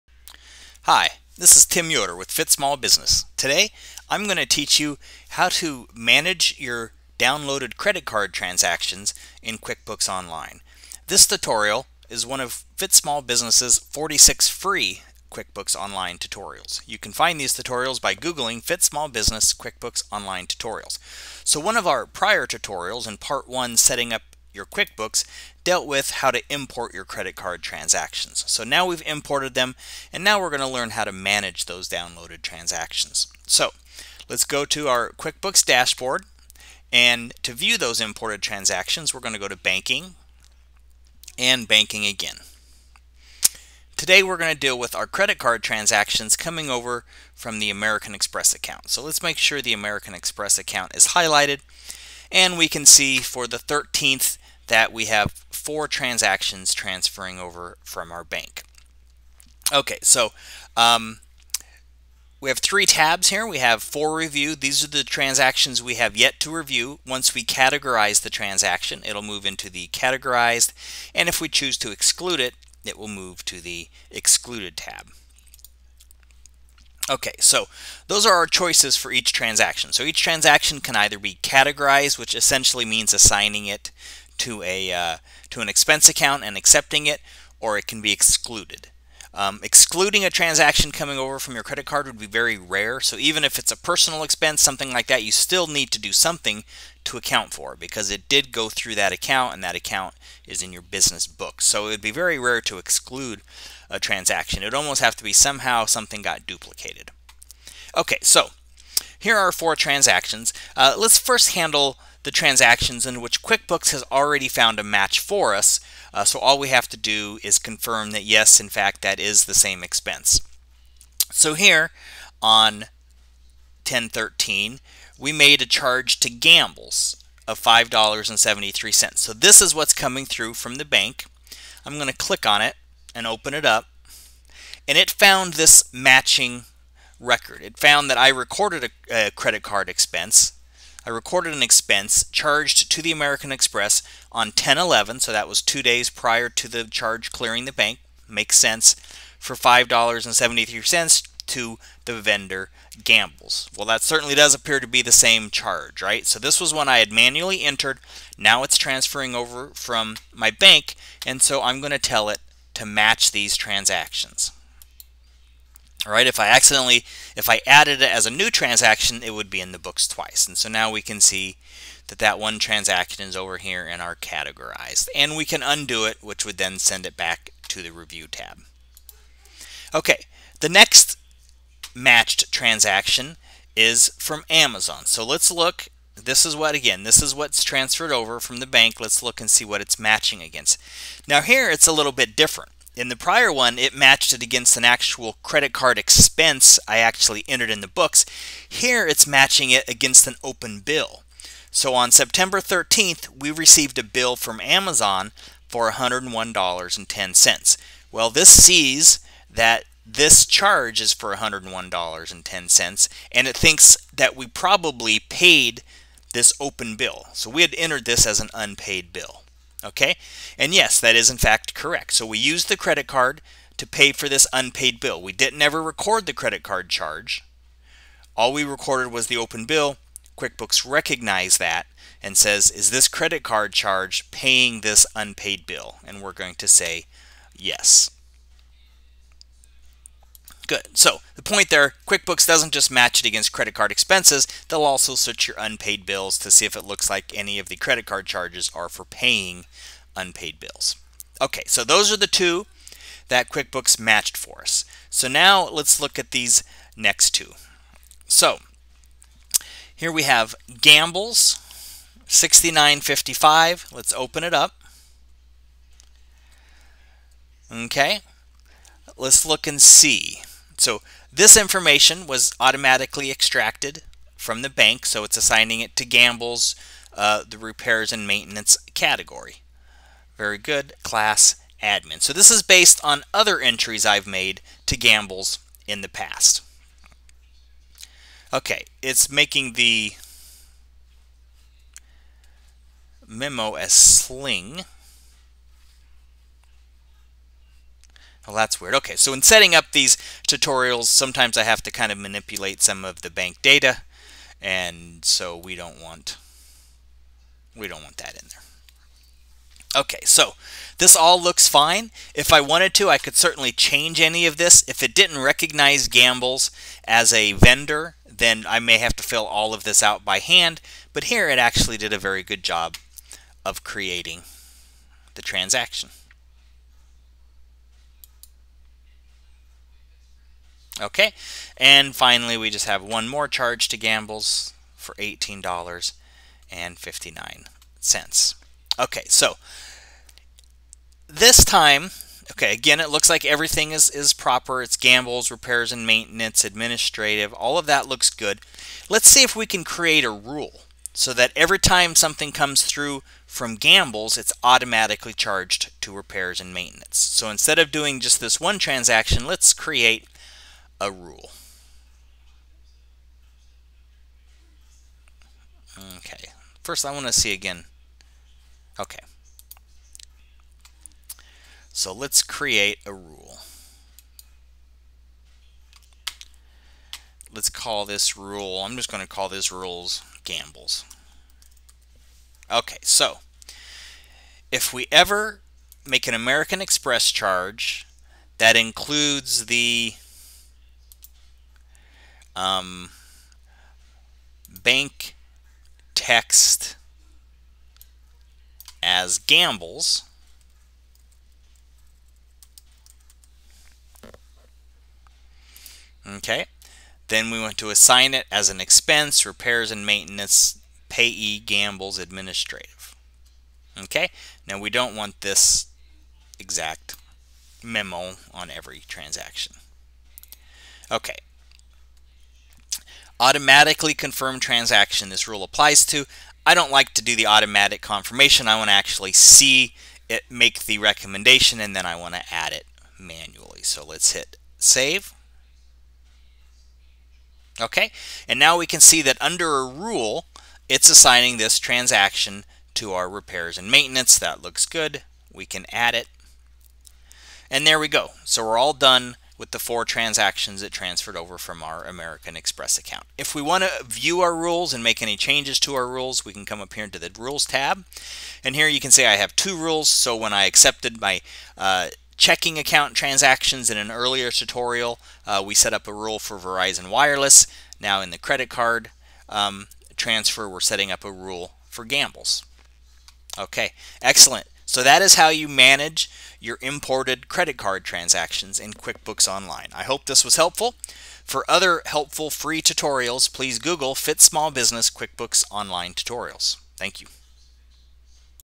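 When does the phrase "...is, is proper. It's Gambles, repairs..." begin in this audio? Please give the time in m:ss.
5:43.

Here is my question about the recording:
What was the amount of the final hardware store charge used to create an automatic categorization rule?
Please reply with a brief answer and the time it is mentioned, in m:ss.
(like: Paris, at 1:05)
$18.59, at 5:35.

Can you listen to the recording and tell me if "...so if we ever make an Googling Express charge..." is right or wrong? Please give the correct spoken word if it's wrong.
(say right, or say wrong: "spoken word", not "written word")
wrong: "American", not "Googling".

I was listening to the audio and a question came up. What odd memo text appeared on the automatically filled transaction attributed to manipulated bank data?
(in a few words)
sling.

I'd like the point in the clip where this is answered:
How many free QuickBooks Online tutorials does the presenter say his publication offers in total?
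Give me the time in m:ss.
0:13.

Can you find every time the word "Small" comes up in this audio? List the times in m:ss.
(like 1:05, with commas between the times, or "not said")
0:02, 0:12, 0:18, 8:04.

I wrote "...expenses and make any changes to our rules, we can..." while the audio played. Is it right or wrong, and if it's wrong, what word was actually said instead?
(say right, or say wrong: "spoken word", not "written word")
wrong: "rules", not "expenses".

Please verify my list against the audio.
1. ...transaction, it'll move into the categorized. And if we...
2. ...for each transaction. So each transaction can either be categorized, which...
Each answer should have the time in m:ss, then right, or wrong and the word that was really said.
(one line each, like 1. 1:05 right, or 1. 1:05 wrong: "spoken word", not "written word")
1. 1:08 right
2. 1:18 right.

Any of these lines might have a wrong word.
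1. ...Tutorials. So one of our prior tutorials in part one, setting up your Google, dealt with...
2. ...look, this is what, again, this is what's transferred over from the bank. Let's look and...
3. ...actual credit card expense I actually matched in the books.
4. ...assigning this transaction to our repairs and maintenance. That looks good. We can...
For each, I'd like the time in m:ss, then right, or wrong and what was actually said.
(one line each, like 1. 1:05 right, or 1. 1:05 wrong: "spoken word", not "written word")
1. 0:20 wrong: "QuickBooks", not "Google"
2. 3:05 right
3. 3:14 wrong: "entered", not "matched"
4. 7:21 right.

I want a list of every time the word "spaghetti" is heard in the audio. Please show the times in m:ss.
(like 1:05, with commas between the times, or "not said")
not said.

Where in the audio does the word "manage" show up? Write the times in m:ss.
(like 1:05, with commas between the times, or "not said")
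0:05, 0:31, 7:55.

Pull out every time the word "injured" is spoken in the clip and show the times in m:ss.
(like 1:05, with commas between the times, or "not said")
not said.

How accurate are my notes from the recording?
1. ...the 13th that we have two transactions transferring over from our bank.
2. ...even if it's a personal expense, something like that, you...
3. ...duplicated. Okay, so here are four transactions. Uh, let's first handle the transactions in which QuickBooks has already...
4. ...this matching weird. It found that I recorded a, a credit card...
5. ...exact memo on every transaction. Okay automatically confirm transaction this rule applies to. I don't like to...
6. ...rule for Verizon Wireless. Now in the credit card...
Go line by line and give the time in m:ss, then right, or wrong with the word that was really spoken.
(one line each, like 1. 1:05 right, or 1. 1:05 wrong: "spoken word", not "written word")
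1. 0:53 wrong: "four", not "two"
2. 1:33 right
3. 1:46 right
4. 2:15 wrong: "record", not "weird"
5. 6:56 right
6. 7:46 right.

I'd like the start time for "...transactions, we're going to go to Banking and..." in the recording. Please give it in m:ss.
0:38.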